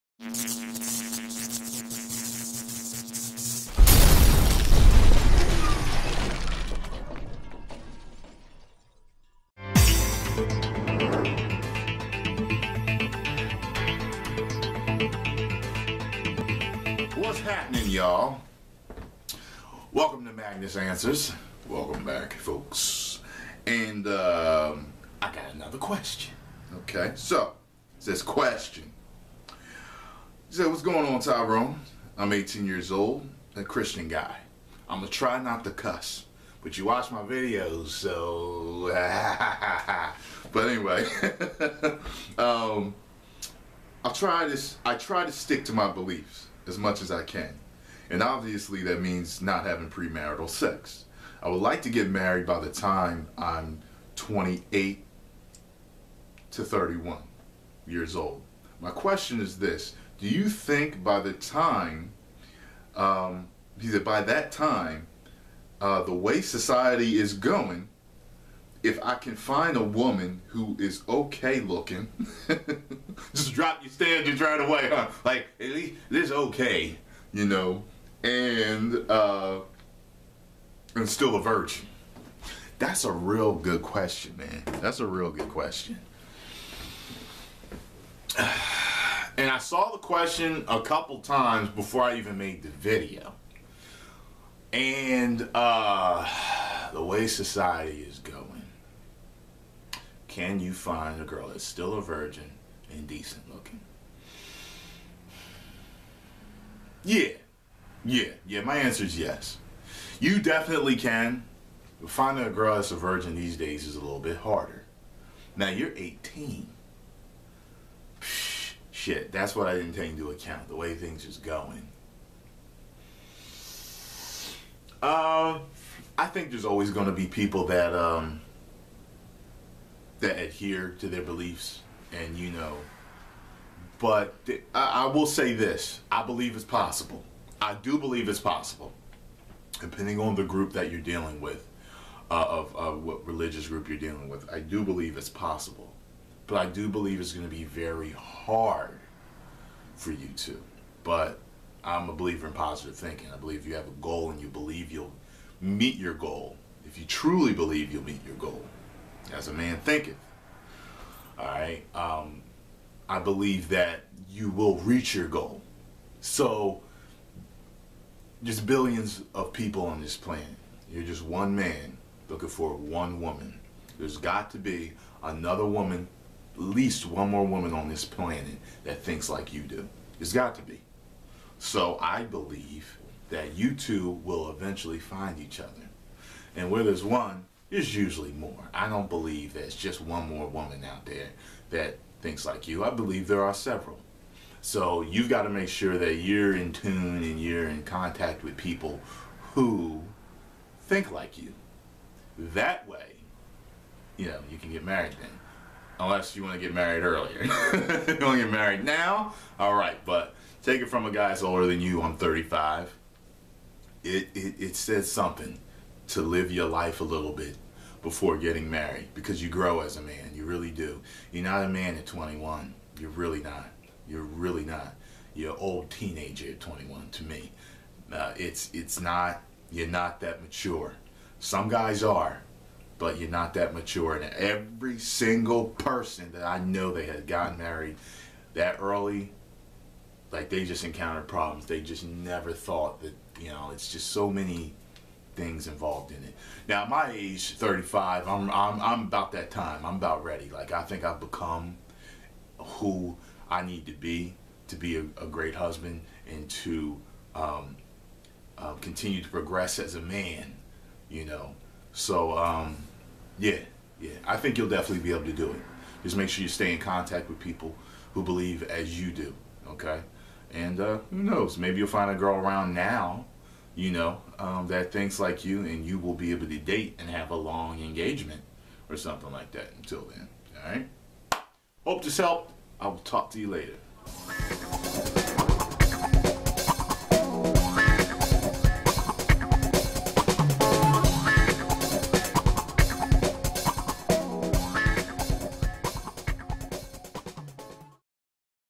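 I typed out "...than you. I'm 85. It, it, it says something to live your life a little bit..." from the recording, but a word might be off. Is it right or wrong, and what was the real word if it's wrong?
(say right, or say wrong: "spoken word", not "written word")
wrong: "35", not "85".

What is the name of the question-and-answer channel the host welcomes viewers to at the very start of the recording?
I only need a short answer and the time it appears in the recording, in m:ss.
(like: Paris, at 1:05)
Magnus Answers, at 0:20.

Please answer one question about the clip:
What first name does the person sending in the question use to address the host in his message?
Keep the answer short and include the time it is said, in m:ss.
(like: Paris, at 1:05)
Tyrone, at 0:31.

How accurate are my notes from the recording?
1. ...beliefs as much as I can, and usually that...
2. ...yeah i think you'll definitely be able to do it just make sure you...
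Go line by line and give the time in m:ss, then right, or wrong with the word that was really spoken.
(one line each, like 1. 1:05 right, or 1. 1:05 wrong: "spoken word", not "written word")
1. 0:45 wrong: "obviously", not "usually"
2. 4:23 right.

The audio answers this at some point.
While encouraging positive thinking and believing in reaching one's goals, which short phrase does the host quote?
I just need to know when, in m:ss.
2:39.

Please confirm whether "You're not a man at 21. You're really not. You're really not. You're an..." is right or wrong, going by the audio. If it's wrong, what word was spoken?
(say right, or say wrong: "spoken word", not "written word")
right.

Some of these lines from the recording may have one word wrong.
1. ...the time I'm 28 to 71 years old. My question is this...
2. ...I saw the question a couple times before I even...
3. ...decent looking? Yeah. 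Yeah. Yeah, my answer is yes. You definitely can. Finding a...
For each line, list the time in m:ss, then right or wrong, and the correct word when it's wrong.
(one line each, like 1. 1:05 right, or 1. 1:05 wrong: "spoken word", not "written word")
1. 0:52 wrong: "31", not "71"
2. 1:29 right
3. 1:43 right.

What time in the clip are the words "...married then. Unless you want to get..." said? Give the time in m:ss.
3:24.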